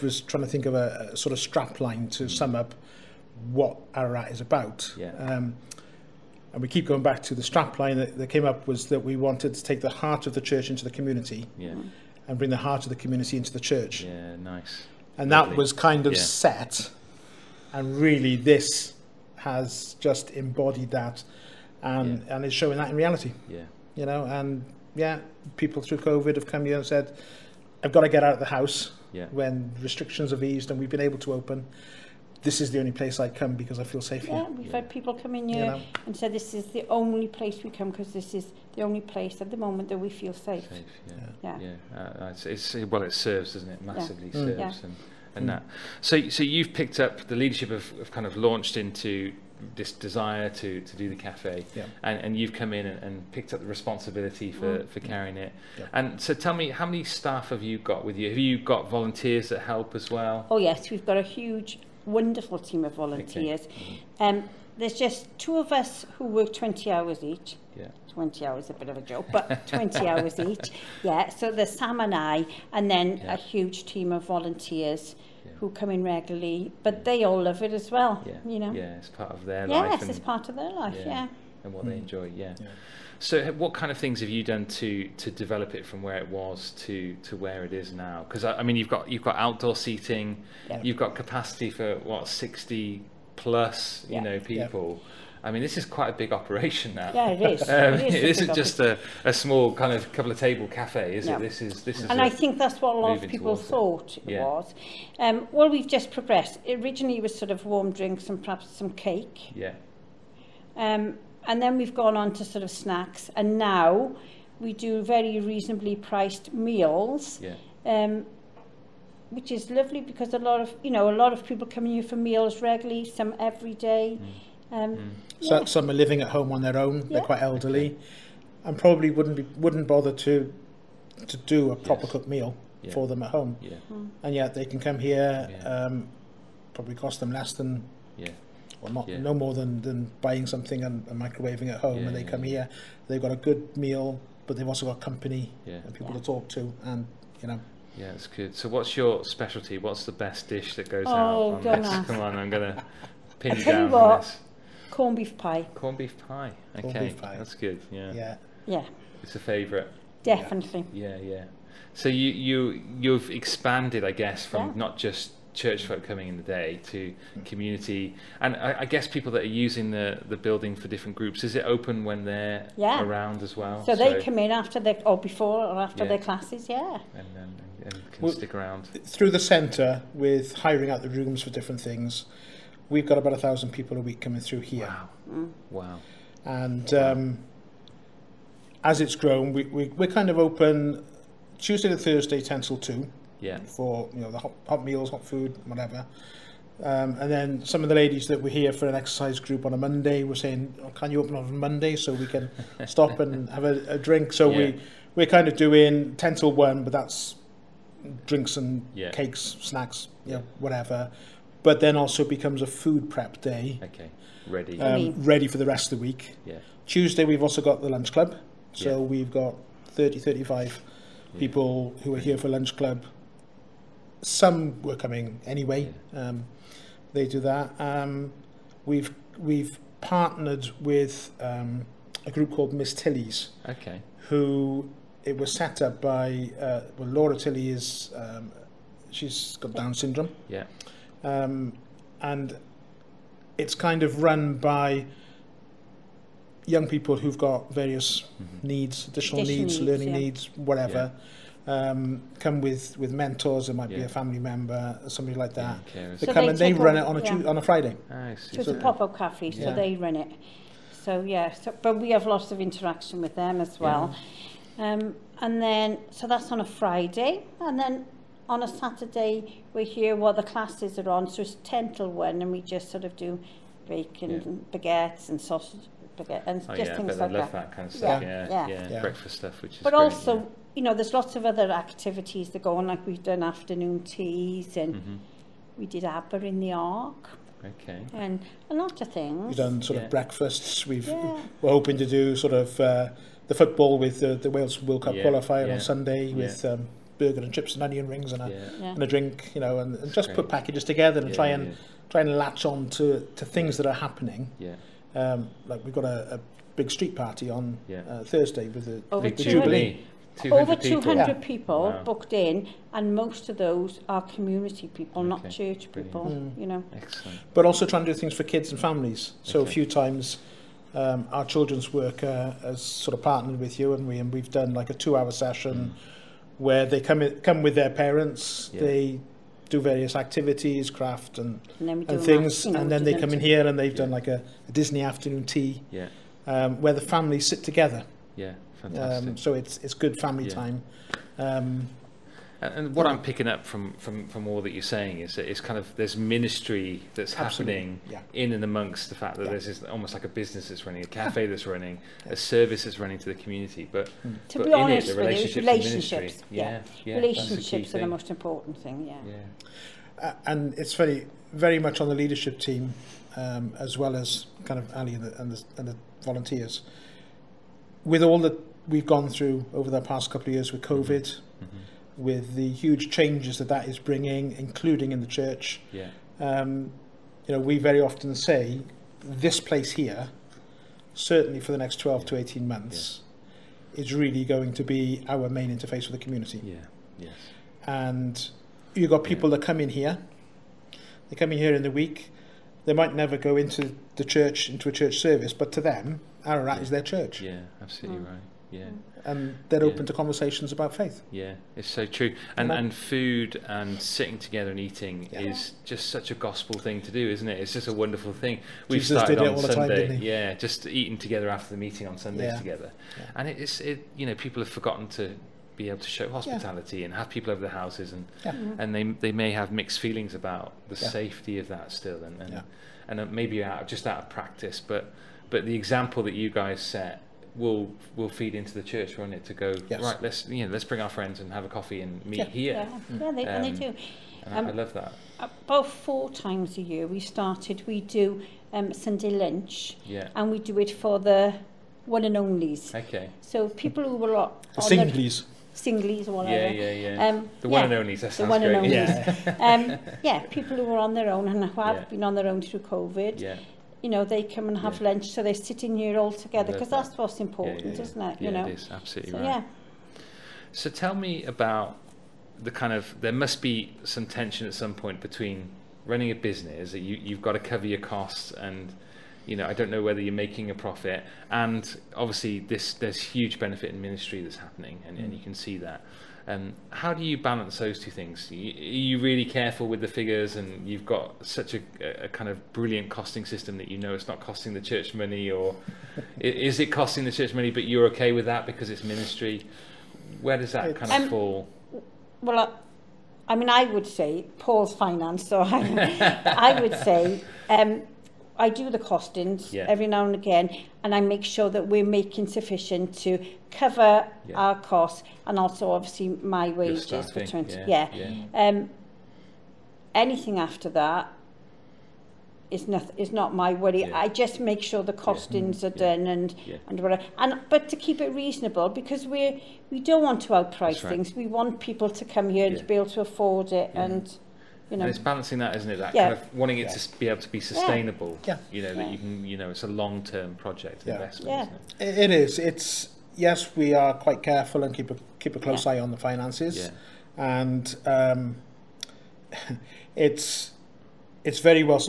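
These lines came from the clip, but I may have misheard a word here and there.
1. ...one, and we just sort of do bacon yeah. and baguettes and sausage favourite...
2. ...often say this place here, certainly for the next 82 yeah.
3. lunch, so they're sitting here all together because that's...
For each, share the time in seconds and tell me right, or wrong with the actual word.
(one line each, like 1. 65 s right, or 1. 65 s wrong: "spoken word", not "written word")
1. 272 s wrong: "baguette", not "favourite"
2. 378 s wrong: "12", not "82"
3. 455 s right.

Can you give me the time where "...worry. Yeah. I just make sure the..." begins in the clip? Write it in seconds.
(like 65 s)
513 s.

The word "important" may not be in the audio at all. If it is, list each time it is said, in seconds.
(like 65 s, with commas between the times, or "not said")
358 s, 457 s.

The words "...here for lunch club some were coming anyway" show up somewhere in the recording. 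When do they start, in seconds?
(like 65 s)
222 s.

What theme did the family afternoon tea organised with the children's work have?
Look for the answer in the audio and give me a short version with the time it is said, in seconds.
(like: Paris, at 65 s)
Disney, at 334 s.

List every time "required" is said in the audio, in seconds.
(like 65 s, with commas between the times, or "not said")
not said.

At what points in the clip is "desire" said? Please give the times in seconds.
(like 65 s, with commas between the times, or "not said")
49 s.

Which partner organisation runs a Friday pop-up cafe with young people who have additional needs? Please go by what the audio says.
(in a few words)
Miss Tilly's.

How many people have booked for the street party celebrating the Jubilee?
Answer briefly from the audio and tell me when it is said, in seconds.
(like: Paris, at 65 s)
Over 200, at 310 s.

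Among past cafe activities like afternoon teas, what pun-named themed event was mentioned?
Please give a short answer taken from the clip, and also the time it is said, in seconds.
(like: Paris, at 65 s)
Abba in the Ark, at 286 s.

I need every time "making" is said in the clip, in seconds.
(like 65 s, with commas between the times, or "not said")
470 s, 502 s.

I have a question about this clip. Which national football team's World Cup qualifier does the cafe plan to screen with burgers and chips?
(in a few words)
Wales.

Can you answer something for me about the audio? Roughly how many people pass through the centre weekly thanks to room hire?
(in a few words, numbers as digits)
1000.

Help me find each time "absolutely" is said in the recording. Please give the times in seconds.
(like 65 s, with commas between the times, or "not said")
347 s, 397 s, 458 s.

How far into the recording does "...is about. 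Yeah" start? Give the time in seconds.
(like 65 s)
4 s.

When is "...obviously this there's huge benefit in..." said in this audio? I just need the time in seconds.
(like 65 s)
472 s.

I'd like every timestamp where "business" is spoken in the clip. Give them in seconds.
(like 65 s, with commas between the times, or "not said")
350 s, 466 s.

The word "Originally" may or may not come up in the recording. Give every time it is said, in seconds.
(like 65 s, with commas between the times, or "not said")
106 s.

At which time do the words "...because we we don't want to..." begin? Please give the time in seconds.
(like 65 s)
518 s.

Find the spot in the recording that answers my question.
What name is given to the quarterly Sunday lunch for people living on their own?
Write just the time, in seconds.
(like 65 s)
442 s.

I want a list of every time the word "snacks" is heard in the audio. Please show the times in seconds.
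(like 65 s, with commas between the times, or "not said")
112 s, 209 s.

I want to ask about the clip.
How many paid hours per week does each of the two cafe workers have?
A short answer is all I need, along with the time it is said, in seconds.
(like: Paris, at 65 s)
20, at 66 s.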